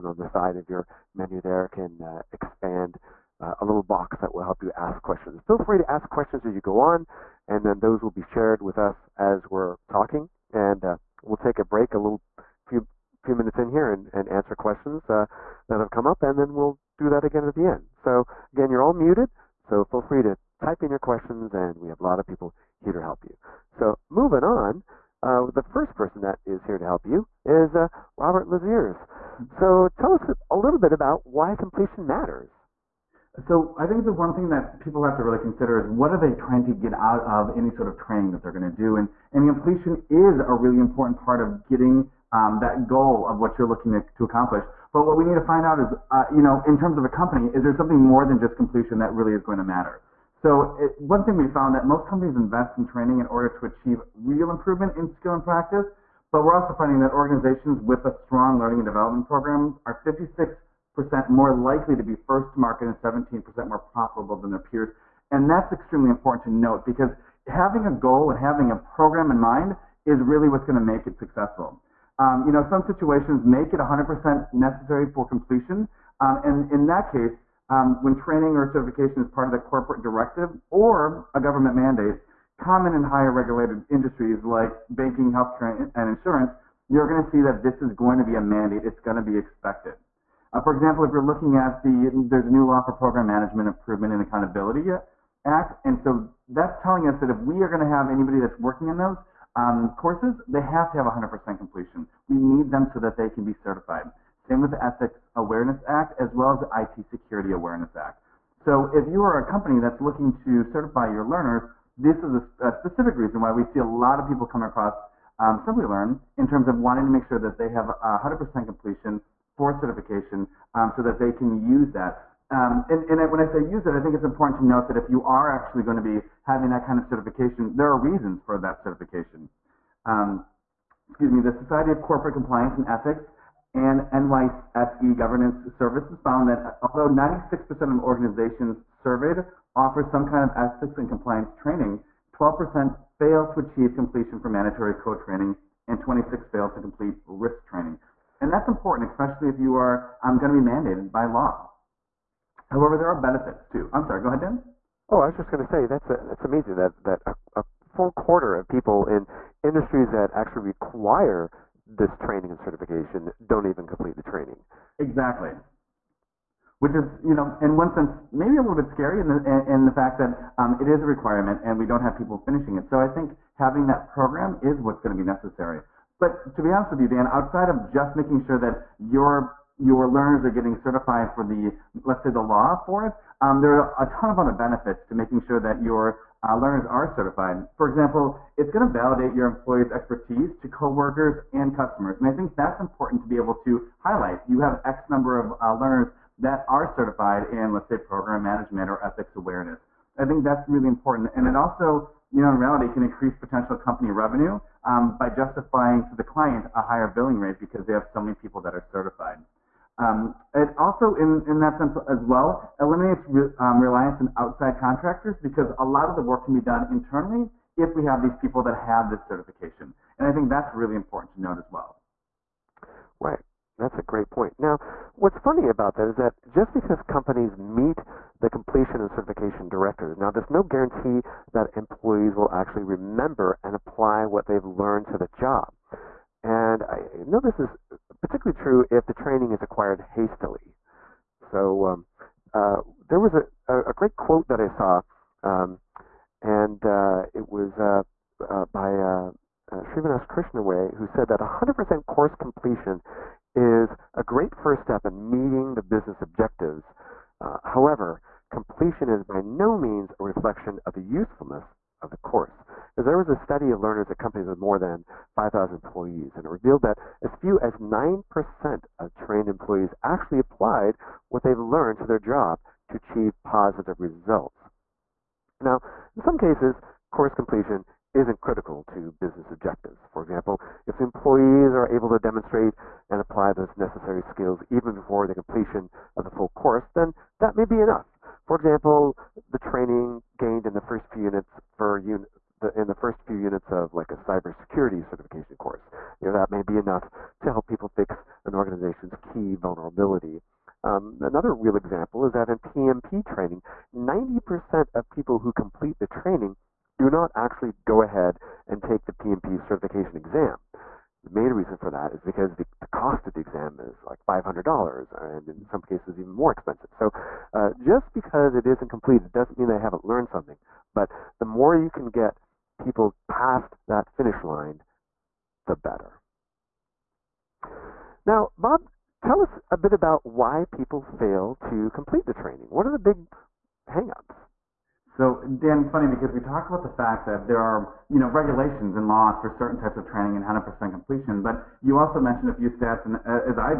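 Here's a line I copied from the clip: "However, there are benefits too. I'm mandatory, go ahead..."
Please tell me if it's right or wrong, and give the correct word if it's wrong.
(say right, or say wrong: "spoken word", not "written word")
wrong: "sorry", not "mandatory".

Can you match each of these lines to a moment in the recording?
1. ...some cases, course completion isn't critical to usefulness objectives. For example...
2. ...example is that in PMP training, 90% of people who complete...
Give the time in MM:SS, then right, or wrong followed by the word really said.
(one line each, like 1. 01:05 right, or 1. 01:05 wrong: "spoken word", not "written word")
1. 04:36 wrong: "business", not "usefulness"
2. 05:01 right.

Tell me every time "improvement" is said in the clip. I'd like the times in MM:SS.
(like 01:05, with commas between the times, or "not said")
00:54, 01:33.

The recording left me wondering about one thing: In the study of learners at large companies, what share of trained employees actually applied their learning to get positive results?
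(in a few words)
9%.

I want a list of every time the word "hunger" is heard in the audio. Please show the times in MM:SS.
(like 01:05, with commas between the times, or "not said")
not said.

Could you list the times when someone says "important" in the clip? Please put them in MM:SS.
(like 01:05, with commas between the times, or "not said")
00:40, 01:06, 02:04, 02:28, 03:12, 03:20, 03:40.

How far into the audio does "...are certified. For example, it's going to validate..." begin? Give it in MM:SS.
03:06.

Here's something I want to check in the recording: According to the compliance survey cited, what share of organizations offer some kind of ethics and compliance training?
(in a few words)
96%.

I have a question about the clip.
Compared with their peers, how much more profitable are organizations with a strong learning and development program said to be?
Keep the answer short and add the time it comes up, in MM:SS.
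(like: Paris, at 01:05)
17%, at 01:02.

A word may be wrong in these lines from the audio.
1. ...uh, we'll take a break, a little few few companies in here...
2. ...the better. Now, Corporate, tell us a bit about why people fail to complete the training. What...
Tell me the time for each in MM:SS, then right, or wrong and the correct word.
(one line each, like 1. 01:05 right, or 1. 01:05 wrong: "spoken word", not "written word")
1. 00:10 wrong: "minutes", not "companies"
2. 05:25 wrong: "Bob", not "Corporate".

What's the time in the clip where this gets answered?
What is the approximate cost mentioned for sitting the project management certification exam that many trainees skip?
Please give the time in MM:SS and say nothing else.
05:14.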